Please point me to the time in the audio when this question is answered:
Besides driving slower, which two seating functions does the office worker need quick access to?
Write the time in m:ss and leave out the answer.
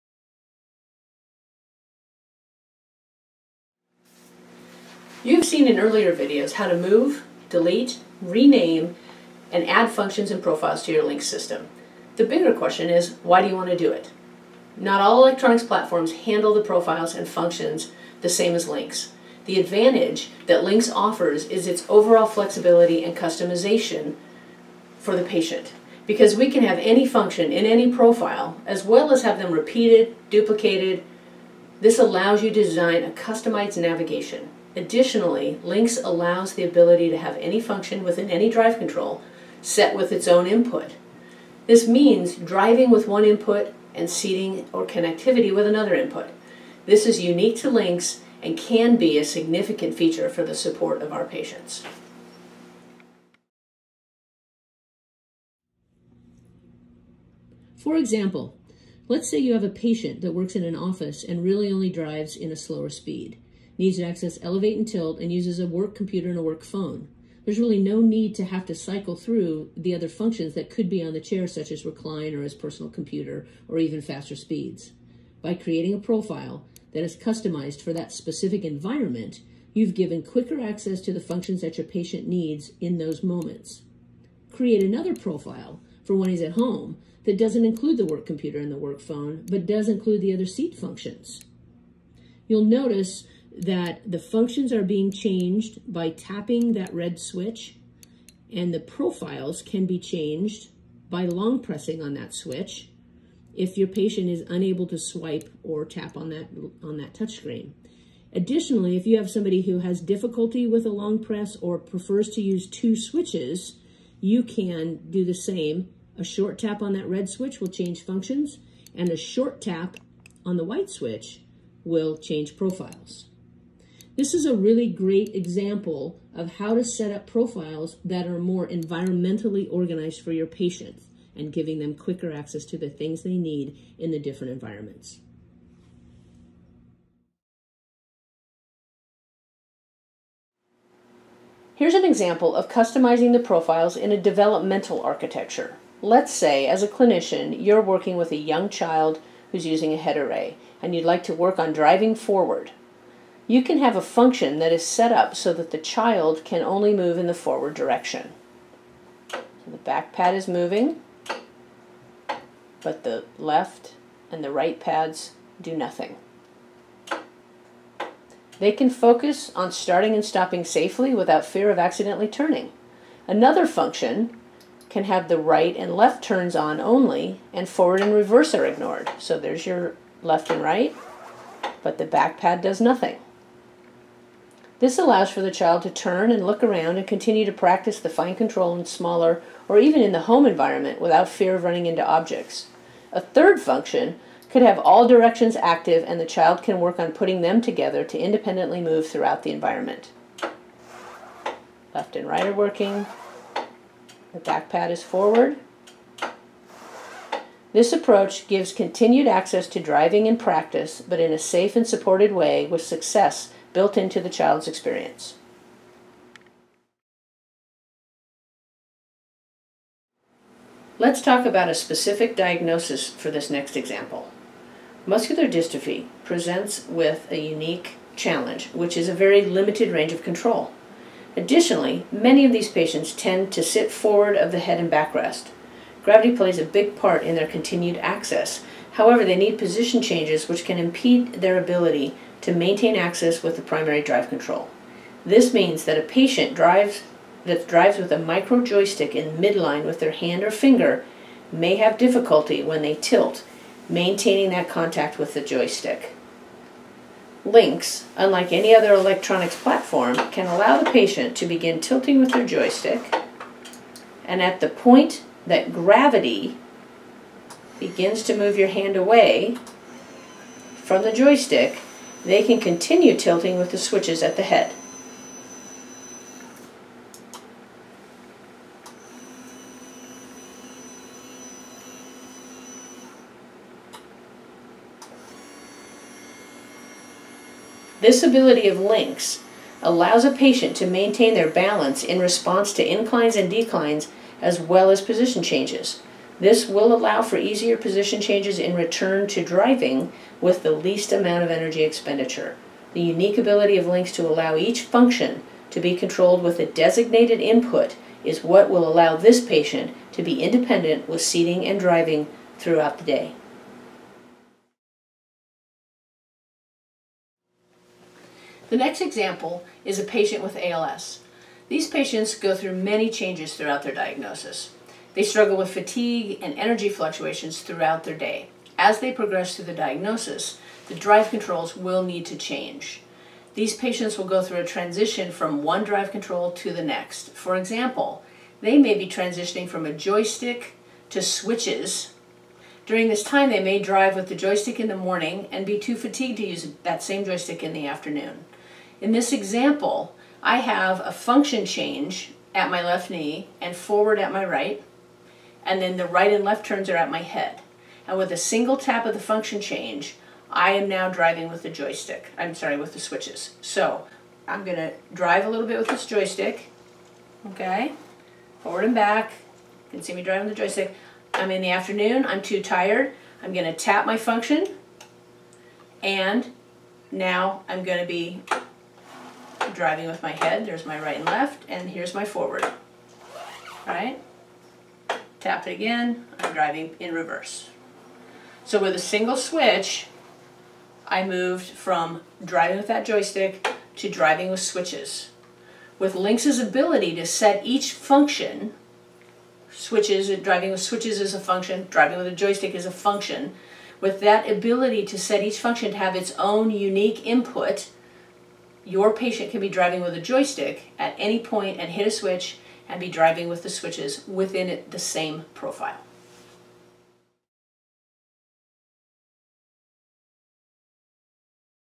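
1:04.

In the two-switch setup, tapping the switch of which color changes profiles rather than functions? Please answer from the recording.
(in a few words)
White.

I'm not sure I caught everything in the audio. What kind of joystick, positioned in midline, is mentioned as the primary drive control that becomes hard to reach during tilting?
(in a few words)
Micro joystick.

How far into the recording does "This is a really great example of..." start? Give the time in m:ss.
2:04.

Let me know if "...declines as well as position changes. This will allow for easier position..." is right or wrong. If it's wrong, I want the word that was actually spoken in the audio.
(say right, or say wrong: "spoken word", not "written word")
right.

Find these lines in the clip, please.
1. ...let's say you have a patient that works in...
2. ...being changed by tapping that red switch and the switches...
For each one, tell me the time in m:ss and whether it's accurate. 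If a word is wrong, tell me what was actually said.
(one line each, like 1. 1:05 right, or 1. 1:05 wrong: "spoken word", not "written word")
1. 0:59 right
2. 1:34 wrong: "profiles", not "switches".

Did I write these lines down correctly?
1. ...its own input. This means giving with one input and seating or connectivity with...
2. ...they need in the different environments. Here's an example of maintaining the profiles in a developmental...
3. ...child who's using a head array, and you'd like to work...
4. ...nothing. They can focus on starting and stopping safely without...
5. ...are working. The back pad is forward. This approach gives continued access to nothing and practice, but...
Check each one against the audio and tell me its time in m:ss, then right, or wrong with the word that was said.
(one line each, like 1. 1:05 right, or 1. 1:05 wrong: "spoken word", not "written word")
1. 0:40 wrong: "driving", not "giving"
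2. 2:13 wrong: "customizing", not "maintaining"
3. 2:28 right
4. 2:45 right
5. 3:22 wrong: "driving", not "nothing".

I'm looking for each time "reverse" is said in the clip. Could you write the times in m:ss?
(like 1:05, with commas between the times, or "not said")
2:58, 6:27.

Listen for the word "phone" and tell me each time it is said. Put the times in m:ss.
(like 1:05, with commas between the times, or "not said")
1:06, 1:28.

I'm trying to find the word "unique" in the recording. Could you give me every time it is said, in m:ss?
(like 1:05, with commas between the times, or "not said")
0:47, 3:47, 5:03, 6:46.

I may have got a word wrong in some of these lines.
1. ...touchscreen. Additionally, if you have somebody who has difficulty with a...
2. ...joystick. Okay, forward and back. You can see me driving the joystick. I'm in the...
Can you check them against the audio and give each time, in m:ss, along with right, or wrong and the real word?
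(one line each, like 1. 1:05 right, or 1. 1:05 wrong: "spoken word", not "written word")
1. 1:47 right
2. 6:06 right.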